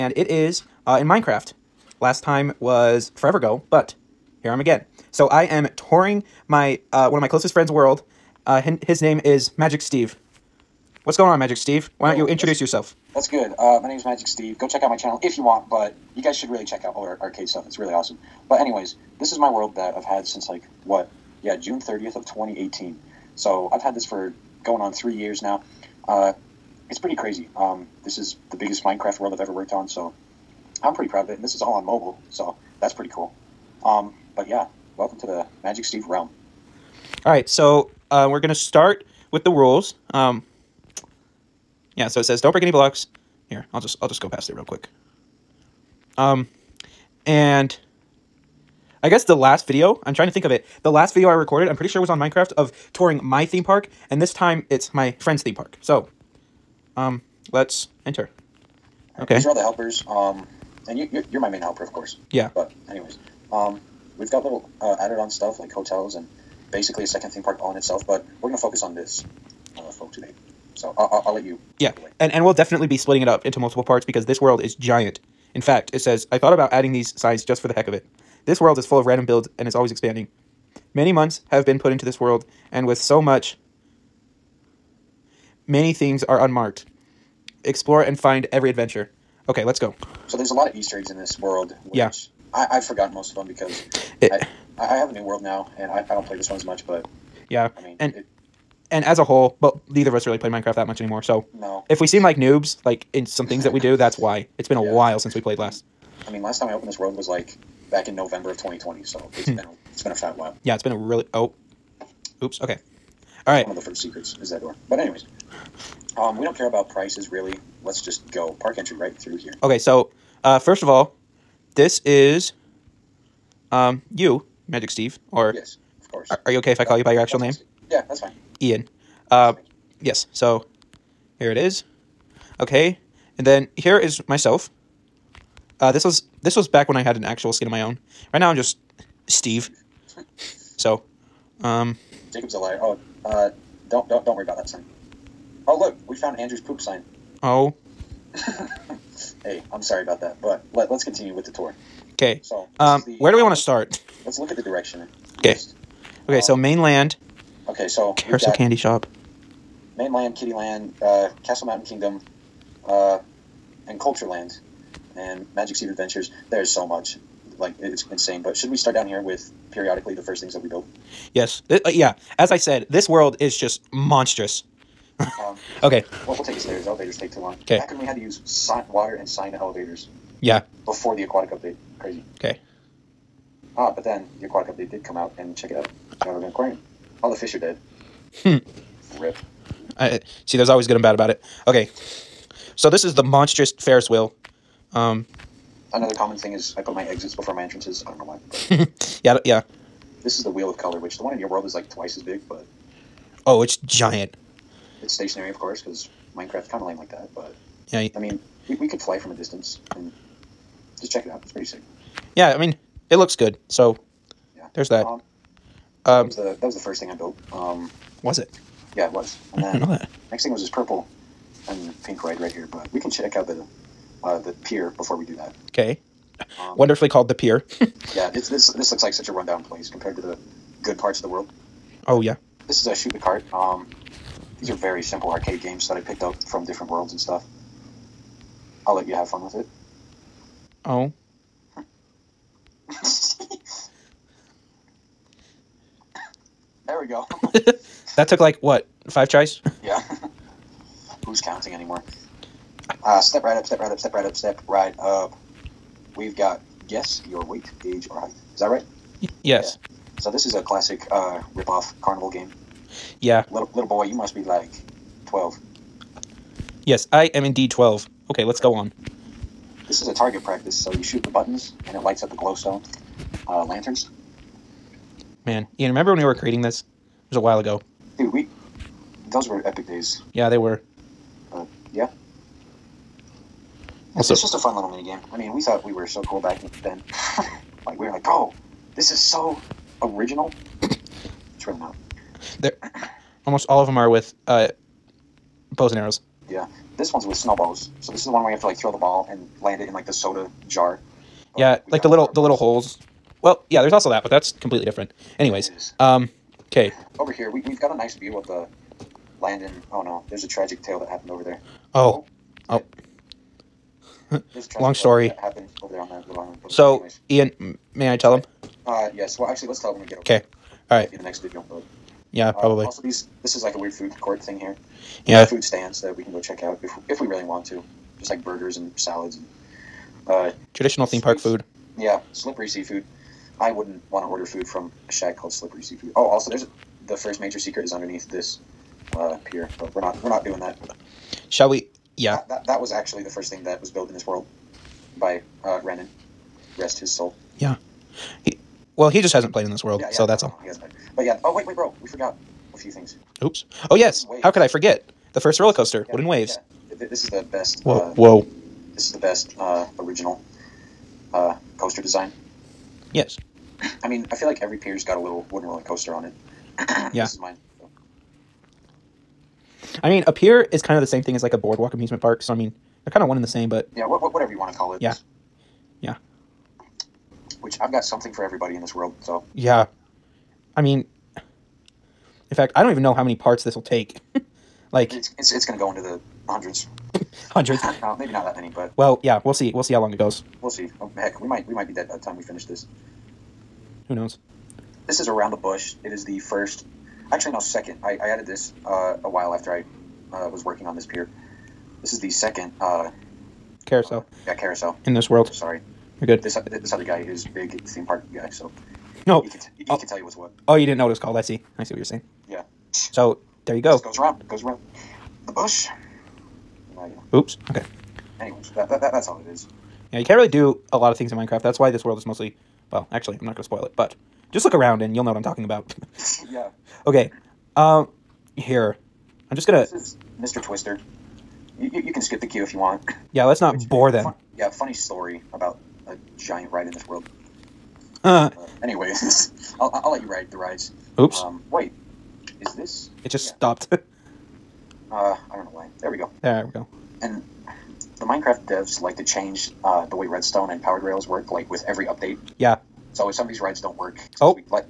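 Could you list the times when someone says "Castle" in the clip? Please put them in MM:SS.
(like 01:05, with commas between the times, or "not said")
02:41.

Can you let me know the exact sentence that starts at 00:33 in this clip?
Um, but yeah, welcome to the Magic Steve realm.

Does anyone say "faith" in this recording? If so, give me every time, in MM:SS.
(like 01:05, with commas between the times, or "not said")
not said.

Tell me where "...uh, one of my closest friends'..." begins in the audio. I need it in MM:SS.
00:06.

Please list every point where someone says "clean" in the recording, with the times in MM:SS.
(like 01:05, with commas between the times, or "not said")
not said.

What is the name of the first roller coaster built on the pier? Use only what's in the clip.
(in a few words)
Wooden Waves.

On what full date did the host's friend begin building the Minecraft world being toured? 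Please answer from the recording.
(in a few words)
June 30, 2018.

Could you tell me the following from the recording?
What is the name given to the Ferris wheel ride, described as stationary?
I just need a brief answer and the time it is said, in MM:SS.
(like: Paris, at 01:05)
Wheel of Color, at 03:20.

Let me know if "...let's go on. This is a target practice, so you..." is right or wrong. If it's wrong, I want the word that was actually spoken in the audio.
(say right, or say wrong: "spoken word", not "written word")
right.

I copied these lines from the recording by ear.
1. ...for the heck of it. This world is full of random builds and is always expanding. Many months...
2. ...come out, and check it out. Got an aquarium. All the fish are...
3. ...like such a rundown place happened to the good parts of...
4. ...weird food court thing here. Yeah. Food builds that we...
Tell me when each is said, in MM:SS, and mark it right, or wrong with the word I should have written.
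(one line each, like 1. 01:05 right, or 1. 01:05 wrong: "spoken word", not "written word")
1. 01:17 right
2. 03:05 right
3. 03:49 wrong: "compared", not "happened"
4. 05:23 wrong: "stands", not "builds".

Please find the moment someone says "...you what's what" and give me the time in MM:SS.
06:50.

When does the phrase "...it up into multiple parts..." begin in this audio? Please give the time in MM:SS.
01:13.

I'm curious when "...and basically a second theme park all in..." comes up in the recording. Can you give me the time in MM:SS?
01:06.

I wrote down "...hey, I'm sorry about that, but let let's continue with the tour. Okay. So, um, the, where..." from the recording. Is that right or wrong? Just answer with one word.
right.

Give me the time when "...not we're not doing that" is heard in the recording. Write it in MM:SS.
05:40.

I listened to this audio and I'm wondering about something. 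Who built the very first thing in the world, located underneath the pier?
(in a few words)
Renan.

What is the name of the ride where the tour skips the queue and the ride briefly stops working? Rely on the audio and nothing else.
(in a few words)
Mr. Twister.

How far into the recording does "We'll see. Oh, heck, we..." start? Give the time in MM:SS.
06:30.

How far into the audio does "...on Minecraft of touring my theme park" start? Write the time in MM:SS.
00:52.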